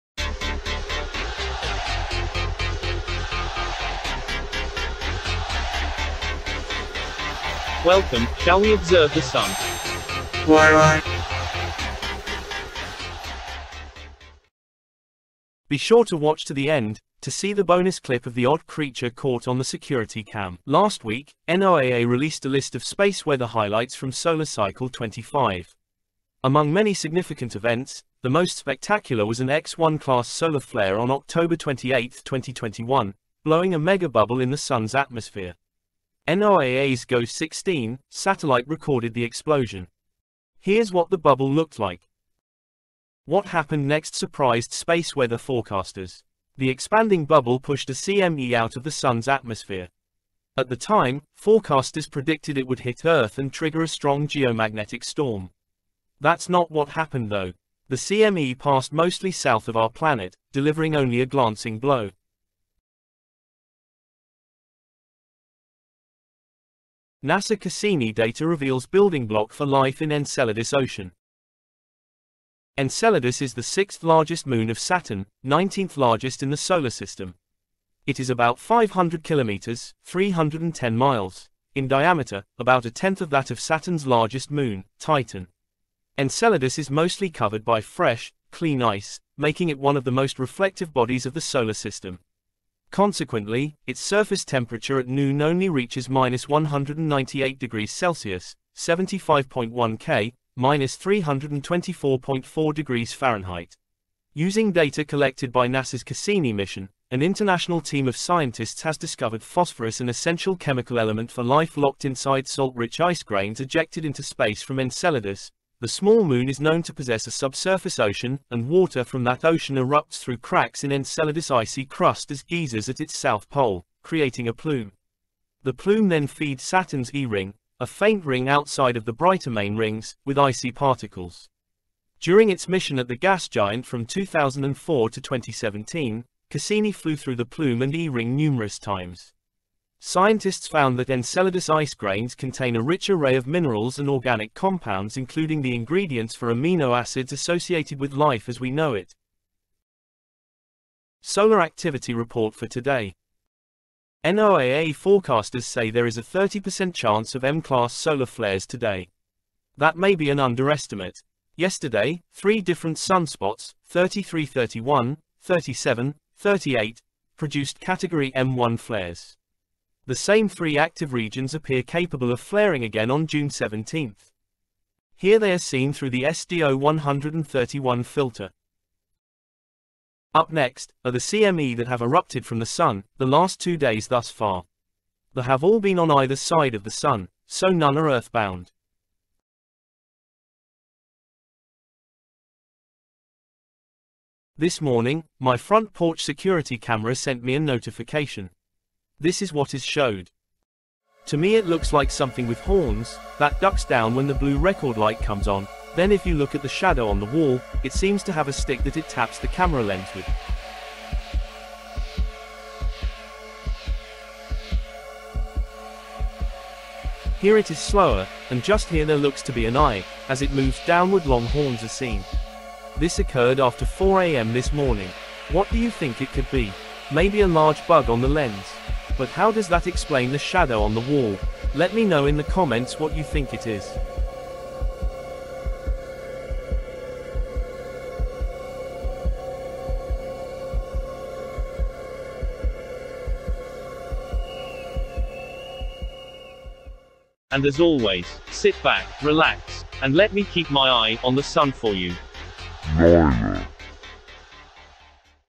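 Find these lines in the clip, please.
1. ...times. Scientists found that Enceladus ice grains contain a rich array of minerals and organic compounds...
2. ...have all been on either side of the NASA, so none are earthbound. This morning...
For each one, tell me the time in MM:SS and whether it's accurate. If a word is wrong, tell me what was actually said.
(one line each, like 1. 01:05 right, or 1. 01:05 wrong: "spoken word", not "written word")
1. 02:18 right
2. 03:05 wrong: "Sun", not "NASA".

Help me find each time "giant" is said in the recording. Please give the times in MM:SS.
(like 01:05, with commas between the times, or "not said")
02:13.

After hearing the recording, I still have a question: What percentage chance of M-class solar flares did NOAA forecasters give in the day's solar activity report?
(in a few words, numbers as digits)
30%.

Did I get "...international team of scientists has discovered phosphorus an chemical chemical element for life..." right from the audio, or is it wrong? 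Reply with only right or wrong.
wrong.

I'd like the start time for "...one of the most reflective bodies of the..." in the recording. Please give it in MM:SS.
01:29.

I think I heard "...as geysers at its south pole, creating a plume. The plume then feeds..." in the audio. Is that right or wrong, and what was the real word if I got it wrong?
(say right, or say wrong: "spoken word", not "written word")
right.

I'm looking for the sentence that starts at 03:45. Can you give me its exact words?
What do you think it could be?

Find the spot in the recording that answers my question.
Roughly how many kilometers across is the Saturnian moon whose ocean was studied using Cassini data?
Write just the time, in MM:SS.
01:18.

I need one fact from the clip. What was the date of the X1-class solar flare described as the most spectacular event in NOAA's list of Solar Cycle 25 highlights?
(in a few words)
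October 28, 2021.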